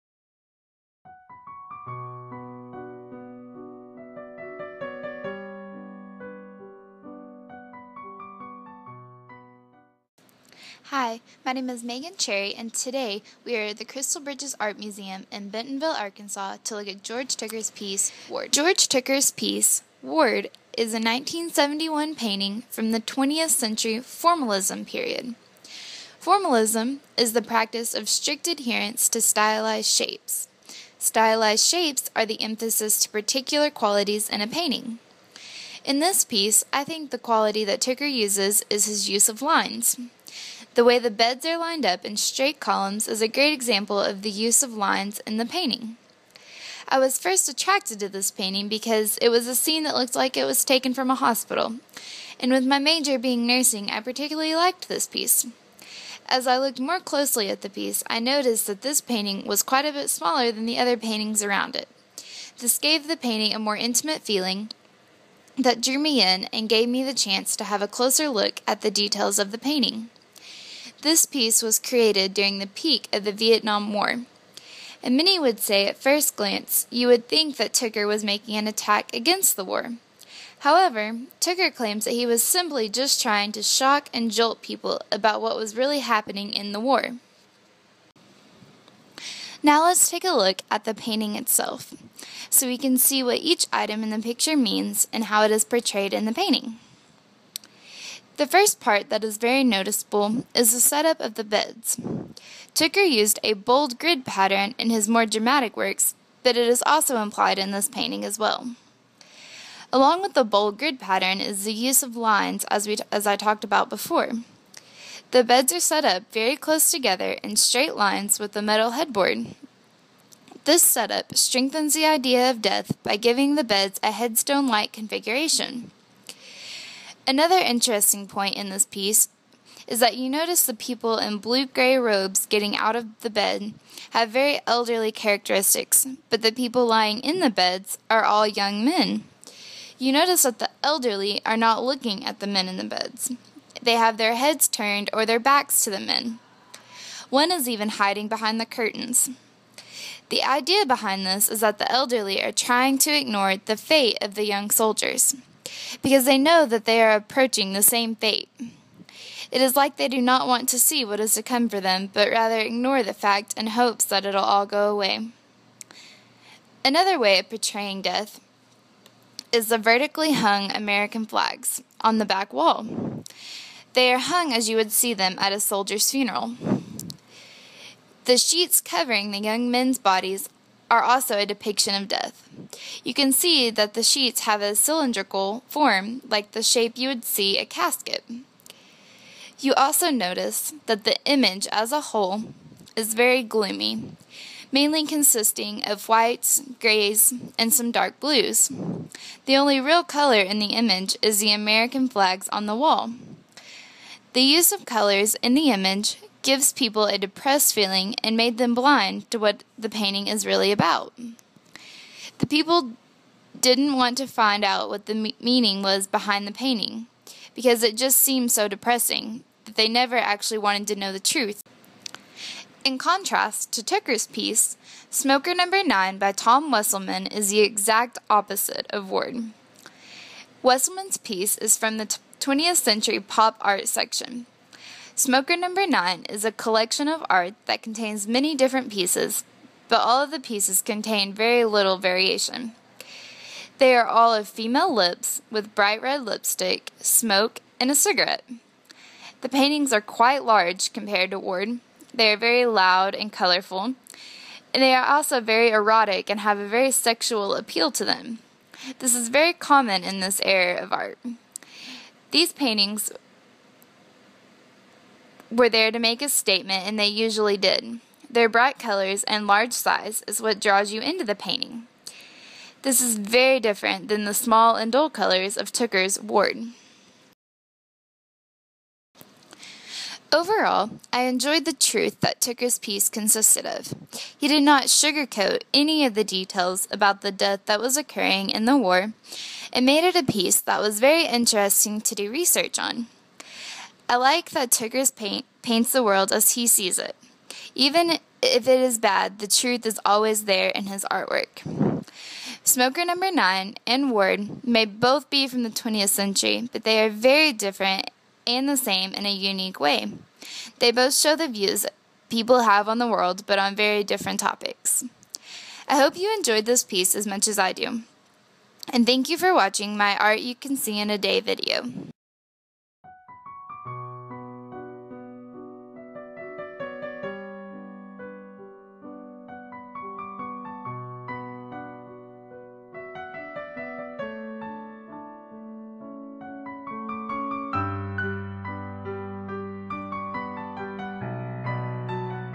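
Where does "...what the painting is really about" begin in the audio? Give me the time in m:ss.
3:29.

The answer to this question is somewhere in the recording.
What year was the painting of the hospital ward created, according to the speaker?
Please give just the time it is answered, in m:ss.
0:20.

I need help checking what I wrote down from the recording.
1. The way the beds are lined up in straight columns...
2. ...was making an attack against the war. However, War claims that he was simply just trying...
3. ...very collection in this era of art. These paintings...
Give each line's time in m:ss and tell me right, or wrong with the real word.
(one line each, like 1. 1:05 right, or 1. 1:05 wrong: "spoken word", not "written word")
1. 0:40 right
2. 1:18 wrong: "Tooker", not "War"
3. 4:19 wrong: "common", not "collection".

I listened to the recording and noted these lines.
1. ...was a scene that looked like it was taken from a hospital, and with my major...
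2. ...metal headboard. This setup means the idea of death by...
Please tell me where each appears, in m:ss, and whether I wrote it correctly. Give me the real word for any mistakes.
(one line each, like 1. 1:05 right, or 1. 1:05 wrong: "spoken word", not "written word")
1. 0:49 right
2. 1:58 wrong: "strengthens", not "means".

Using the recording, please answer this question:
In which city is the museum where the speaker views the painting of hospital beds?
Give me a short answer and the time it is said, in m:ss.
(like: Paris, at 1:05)
Bentonville, at 0:15.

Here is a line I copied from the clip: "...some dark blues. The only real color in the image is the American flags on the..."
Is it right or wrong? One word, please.
right.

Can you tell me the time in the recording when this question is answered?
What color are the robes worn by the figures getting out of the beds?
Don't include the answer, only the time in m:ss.
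2:11.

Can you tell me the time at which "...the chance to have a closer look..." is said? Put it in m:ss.
1:07.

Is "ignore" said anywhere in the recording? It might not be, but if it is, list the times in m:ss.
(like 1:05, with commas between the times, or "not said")
2:33, 2:42.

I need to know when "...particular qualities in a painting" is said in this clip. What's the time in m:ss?
0:33.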